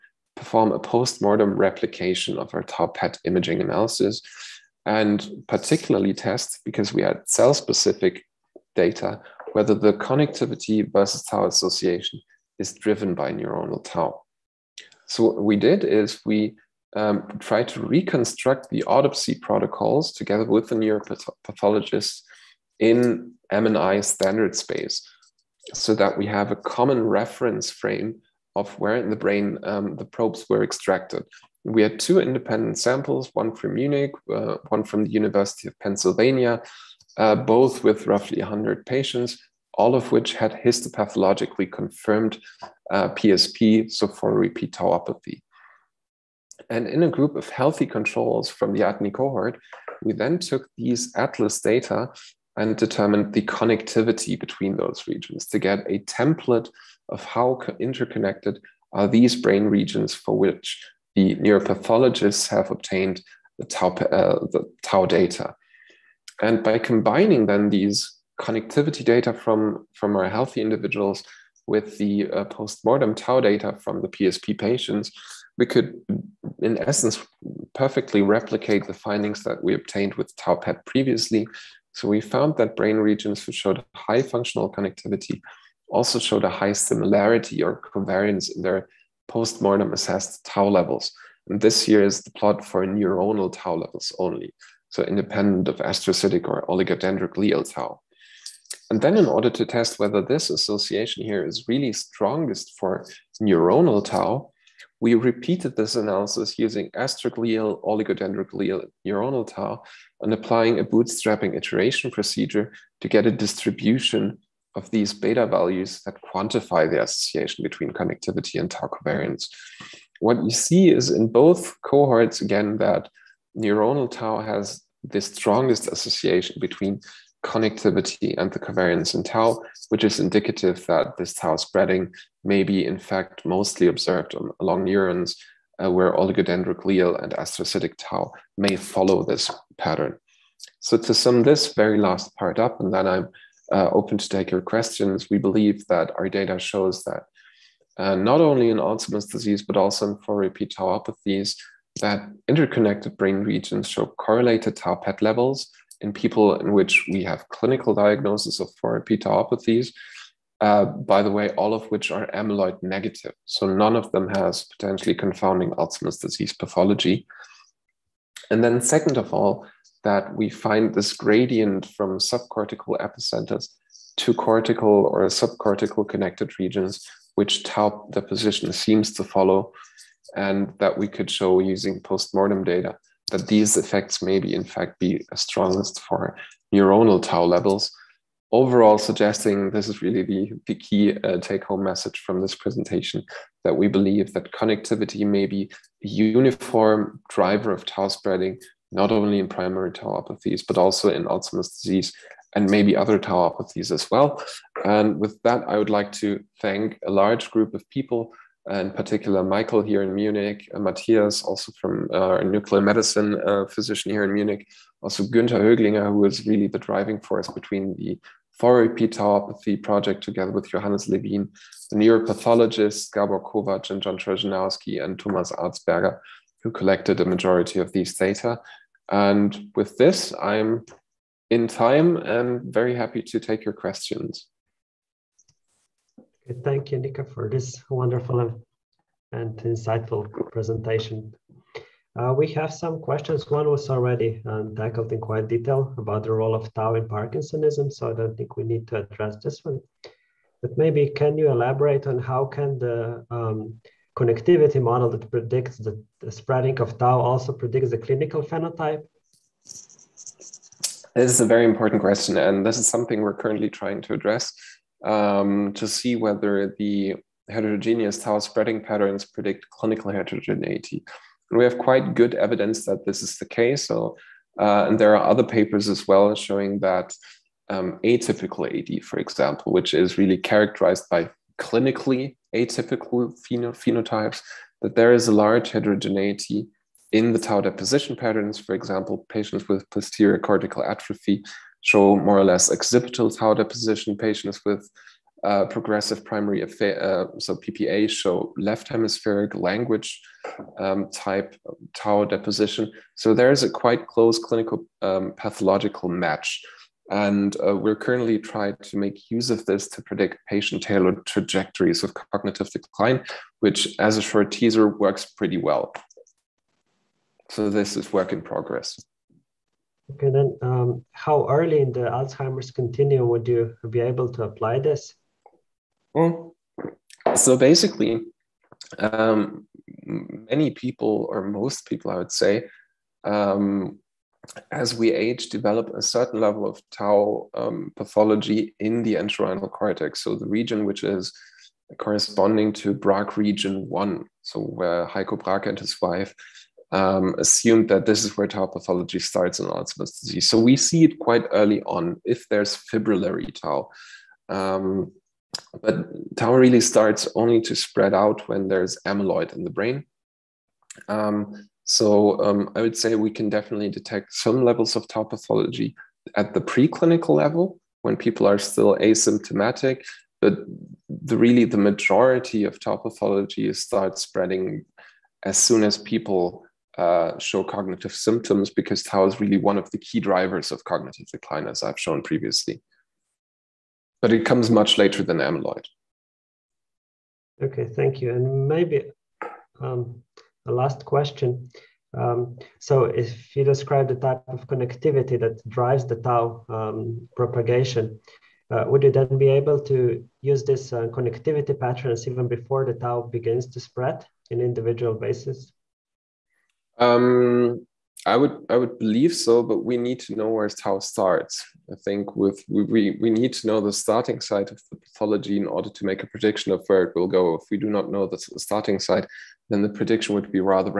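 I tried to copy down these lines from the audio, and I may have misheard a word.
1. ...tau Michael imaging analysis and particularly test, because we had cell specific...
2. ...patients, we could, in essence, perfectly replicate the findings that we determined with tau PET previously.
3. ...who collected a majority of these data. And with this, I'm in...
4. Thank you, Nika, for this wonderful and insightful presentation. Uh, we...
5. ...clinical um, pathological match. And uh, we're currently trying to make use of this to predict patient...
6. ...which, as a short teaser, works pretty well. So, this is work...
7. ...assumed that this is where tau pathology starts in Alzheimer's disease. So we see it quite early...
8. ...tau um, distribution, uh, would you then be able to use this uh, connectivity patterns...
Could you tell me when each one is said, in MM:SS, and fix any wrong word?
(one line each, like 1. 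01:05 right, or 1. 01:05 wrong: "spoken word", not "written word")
1. 00:02 wrong: "PET", not "Michael"
2. 01:14 wrong: "obtained", not "determined"
3. 03:46 right
4. 03:56 right
5. 05:04 right
6. 05:13 right
7. 05:47 right
8. 06:36 wrong: "propagation", not "distribution".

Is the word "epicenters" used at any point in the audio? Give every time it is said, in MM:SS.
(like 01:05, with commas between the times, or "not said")
02:53.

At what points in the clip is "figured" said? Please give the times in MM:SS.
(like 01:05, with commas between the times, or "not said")
not said.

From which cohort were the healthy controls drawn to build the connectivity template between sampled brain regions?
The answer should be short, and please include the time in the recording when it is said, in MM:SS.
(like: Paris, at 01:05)
ADNI, at 00:48.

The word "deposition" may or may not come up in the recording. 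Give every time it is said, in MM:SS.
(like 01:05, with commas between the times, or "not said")
02:58, 04:47, 04:53, 05:02.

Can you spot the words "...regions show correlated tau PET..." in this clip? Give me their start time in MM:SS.
02:33.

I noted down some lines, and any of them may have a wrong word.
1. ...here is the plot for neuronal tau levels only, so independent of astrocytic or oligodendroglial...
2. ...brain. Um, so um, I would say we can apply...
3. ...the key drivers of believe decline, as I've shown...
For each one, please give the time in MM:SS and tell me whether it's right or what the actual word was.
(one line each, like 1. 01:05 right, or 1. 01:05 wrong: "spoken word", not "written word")
1. 01:31 right
2. 05:59 wrong: "definitely", not "apply"
3. 06:19 wrong: "cognitive", not "believe".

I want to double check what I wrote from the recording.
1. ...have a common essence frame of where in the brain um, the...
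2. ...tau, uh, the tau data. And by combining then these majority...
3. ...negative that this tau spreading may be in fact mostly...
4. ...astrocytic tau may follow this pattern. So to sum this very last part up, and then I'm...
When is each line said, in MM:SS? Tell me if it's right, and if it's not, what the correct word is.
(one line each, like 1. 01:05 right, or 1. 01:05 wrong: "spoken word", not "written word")
1. 00:26 wrong: "reference", not "essence"
2. 01:03 wrong: "connectivity", not "majority"
3. 02:10 wrong: "indicative", not "negative"
4. 02:17 right.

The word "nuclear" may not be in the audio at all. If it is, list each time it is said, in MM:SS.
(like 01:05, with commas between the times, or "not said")
03:32.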